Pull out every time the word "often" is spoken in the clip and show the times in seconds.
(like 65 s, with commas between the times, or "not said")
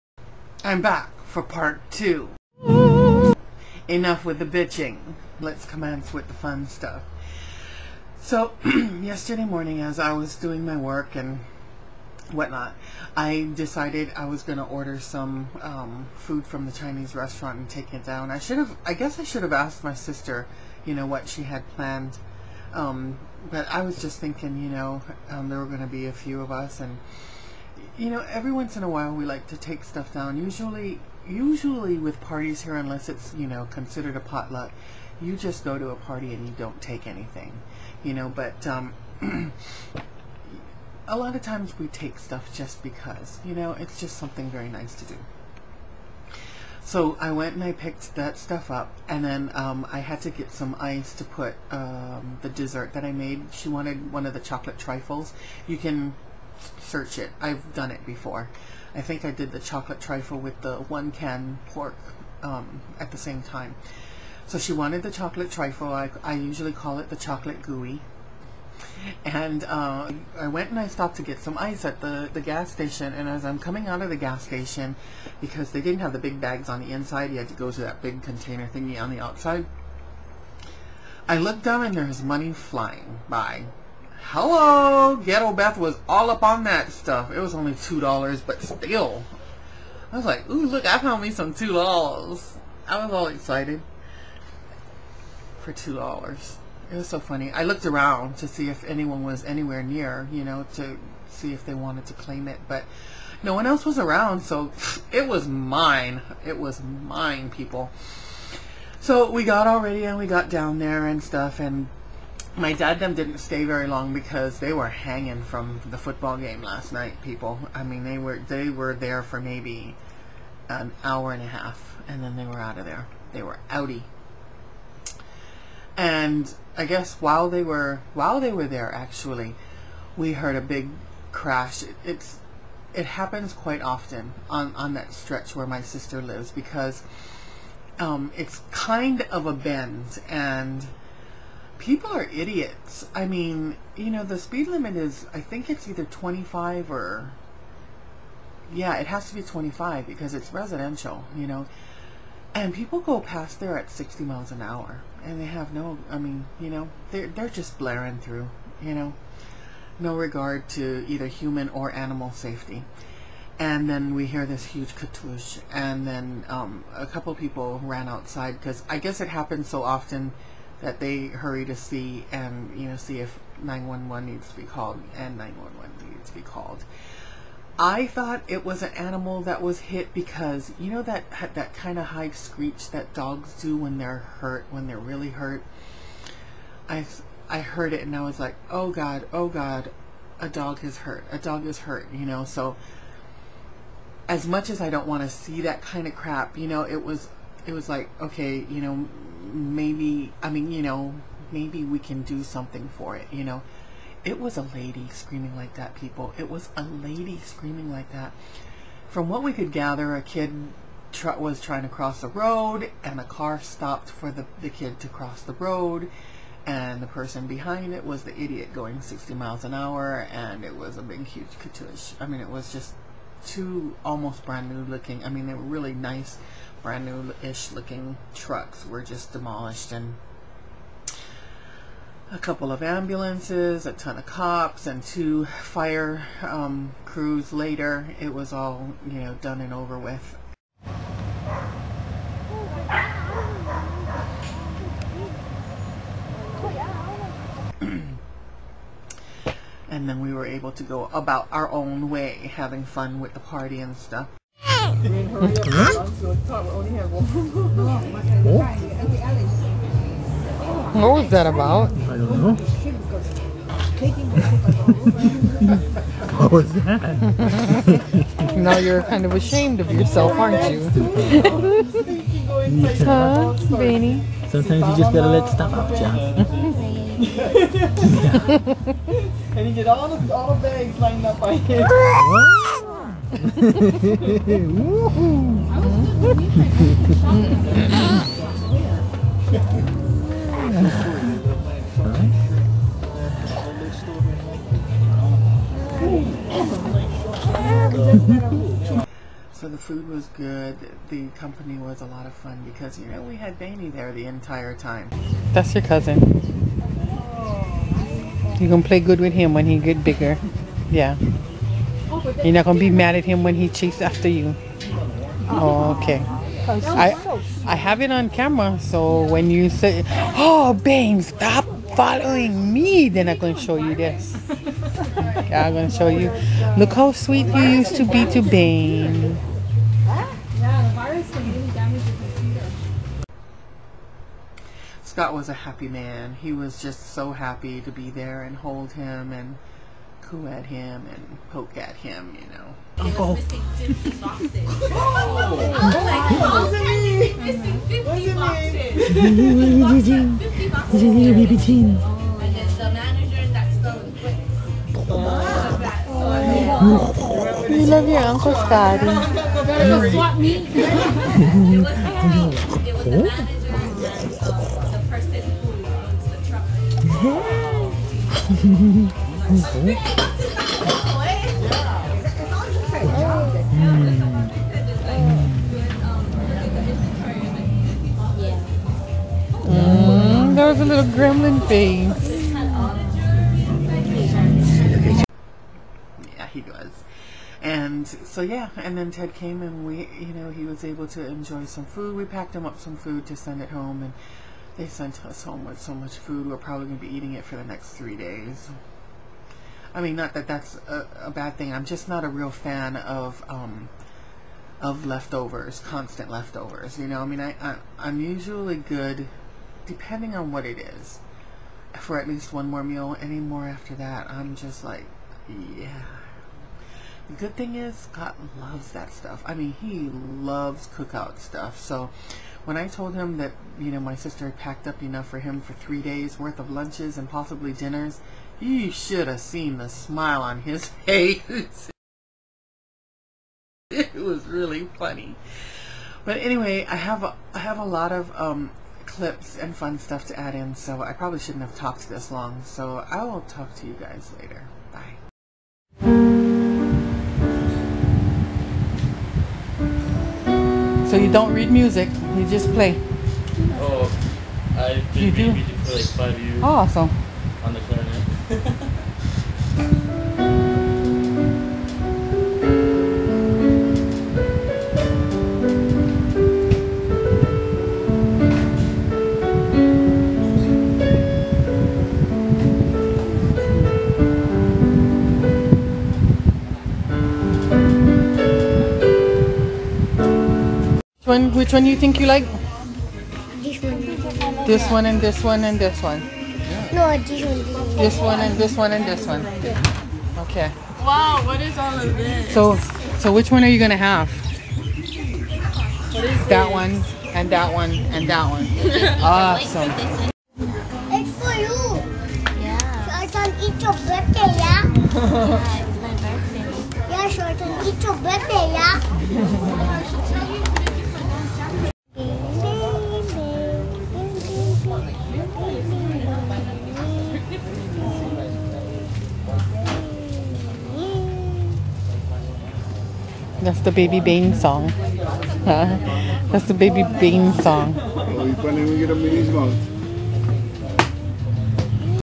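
133 s, 169 s.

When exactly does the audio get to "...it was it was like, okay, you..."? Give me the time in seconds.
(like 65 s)
196 s.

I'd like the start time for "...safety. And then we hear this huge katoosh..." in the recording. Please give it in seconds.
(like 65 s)
162 s.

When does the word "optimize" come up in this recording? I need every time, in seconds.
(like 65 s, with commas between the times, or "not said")
not said.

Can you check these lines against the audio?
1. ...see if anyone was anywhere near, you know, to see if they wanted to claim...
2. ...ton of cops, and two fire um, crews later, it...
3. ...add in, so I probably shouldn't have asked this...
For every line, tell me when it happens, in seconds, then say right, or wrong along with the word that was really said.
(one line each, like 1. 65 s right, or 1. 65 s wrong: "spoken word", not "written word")
1. 98 s right
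2. 233 s right
3. 440 s wrong: "talked", not "asked".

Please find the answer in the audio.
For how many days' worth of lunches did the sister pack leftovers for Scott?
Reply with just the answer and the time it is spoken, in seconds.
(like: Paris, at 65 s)
3, at 425 s.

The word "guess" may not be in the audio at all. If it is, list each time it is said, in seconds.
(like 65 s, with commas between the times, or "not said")
18 s, 126 s, 168 s.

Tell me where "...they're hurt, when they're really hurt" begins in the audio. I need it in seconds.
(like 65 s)
183 s.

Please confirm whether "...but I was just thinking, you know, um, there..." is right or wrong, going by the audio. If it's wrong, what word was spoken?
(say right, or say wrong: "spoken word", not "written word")
right.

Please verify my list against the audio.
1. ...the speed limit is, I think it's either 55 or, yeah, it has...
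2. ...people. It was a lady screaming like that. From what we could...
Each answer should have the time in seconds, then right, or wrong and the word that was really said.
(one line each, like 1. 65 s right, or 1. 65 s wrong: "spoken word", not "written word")
1. 144 s wrong: "25", not "55"
2. 205 s right.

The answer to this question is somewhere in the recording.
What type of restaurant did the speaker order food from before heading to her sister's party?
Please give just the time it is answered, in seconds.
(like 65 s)
16 s.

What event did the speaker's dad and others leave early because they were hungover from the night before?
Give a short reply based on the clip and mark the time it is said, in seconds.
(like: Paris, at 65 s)
football game, at 115 s.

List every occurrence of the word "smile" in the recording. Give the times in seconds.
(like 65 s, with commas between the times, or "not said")
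429 s.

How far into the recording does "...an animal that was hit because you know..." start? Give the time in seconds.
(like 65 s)
178 s.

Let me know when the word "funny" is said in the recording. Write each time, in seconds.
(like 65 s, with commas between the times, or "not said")
97 s, 434 s.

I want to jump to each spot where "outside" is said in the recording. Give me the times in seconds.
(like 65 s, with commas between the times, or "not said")
79 s, 168 s.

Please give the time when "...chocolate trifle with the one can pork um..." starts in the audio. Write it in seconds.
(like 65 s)
59 s.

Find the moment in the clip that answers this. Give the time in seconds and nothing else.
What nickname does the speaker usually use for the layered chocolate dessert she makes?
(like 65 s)
67 s.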